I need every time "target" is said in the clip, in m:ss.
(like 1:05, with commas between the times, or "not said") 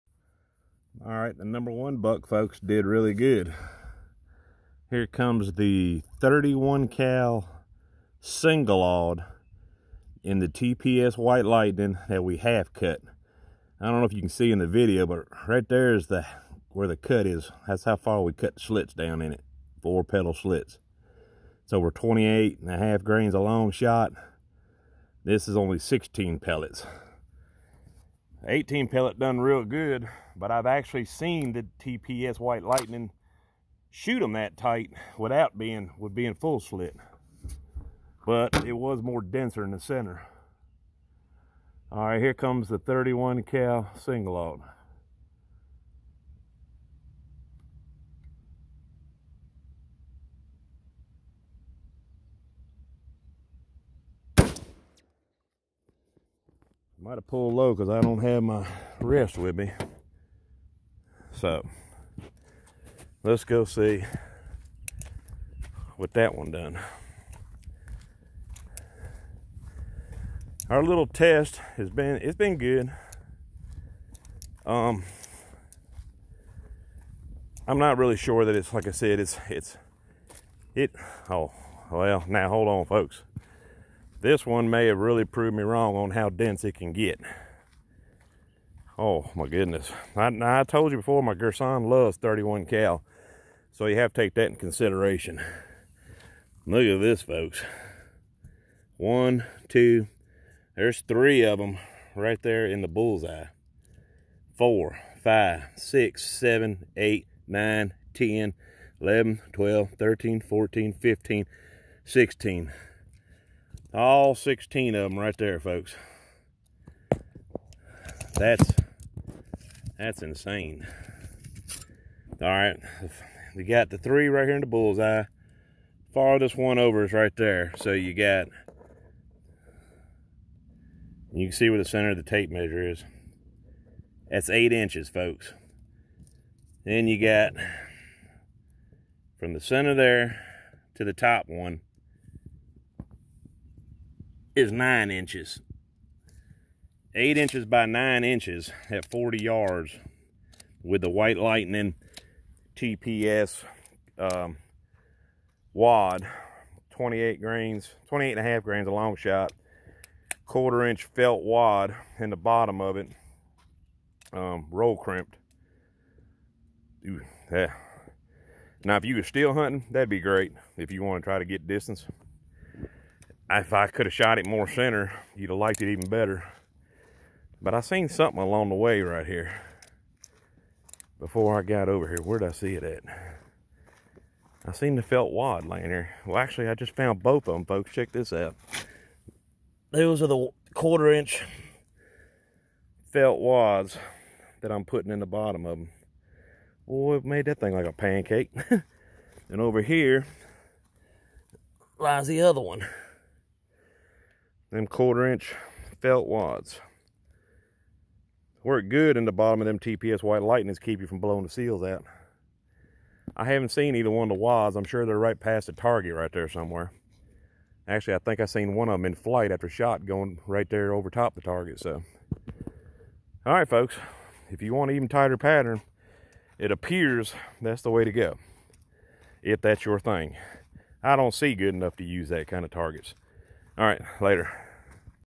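3:35, 3:41, 3:52.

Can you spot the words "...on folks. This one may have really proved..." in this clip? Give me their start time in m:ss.
1:22.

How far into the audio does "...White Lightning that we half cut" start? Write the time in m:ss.
0:11.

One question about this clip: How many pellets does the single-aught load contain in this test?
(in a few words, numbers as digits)
16.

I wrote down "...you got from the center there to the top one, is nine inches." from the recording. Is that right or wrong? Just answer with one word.
right.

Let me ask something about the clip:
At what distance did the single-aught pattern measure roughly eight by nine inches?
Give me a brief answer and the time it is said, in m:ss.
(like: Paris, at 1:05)
40 yards, at 2:29.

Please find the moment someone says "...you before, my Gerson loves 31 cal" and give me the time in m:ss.
1:30.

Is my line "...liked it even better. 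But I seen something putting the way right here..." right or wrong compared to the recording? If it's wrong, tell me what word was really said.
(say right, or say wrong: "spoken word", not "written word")
wrong: "along", not "putting".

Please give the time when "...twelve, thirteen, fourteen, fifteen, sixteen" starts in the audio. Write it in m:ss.
1:49.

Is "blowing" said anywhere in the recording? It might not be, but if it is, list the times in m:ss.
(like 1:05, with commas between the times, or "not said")
3:31.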